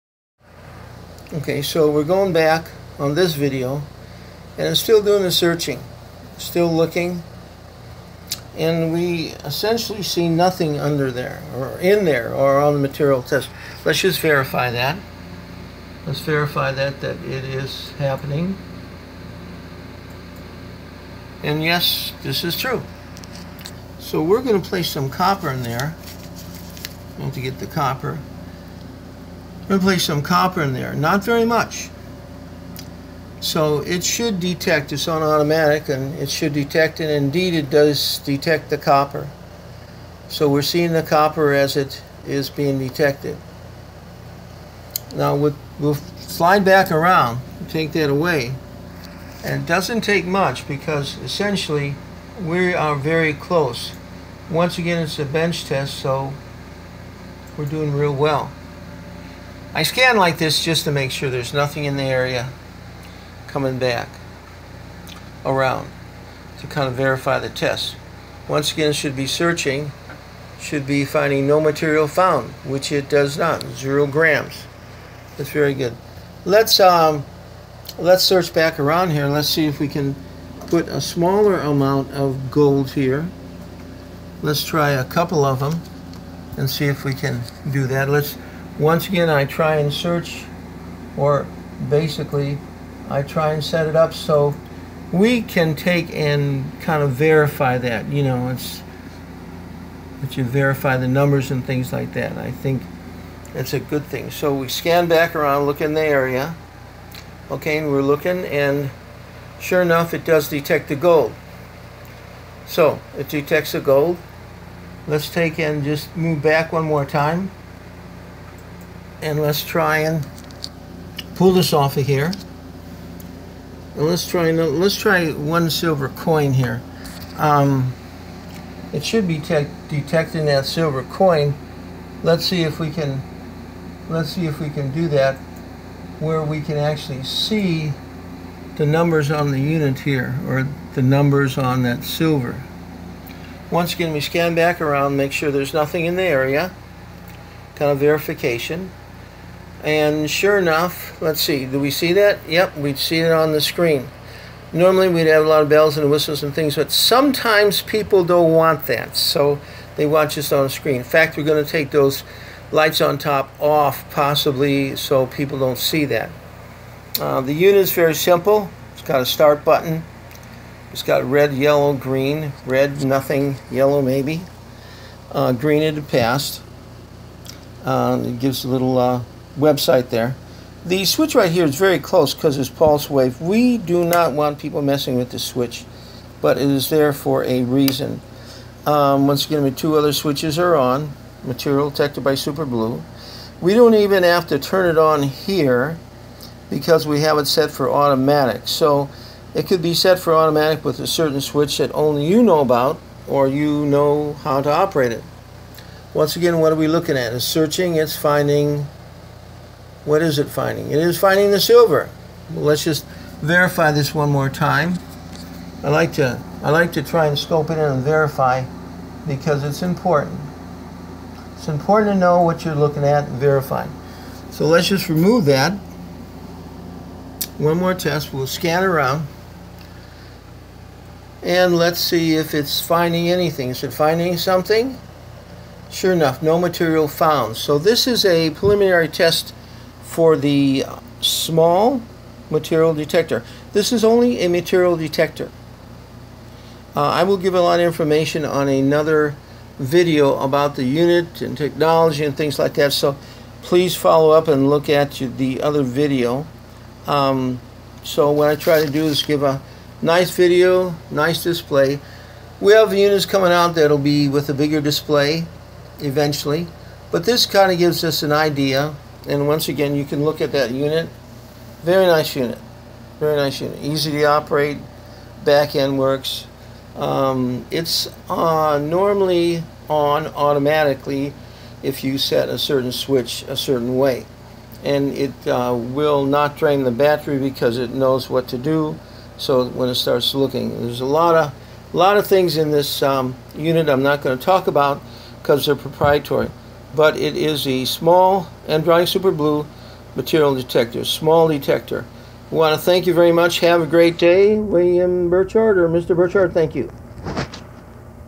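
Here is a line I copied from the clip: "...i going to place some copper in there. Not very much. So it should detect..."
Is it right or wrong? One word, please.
right.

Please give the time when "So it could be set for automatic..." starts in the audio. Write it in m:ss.
3:18.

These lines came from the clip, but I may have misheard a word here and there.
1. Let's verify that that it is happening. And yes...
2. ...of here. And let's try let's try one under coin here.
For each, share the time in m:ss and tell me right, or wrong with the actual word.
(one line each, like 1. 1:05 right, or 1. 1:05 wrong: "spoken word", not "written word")
1. 0:16 right
2. 2:01 wrong: "silver", not "under".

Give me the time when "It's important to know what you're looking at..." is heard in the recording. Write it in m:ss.
3:41.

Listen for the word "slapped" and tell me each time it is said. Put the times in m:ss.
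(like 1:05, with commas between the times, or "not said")
not said.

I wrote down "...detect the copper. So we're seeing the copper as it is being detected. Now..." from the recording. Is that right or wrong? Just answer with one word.
right.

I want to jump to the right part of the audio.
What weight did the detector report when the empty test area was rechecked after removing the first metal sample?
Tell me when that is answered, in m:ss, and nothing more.
1:13.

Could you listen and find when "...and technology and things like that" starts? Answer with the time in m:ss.
4:11.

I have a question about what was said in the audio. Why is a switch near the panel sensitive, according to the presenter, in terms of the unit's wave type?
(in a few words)
Pulse wave.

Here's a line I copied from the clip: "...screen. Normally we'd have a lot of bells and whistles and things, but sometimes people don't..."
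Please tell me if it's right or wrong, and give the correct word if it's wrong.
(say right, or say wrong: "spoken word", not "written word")
right.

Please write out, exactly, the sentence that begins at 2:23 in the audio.
Once again, we scan back around, make sure there's nothing in the area, kind of verification.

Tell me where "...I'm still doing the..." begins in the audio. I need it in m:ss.
0:04.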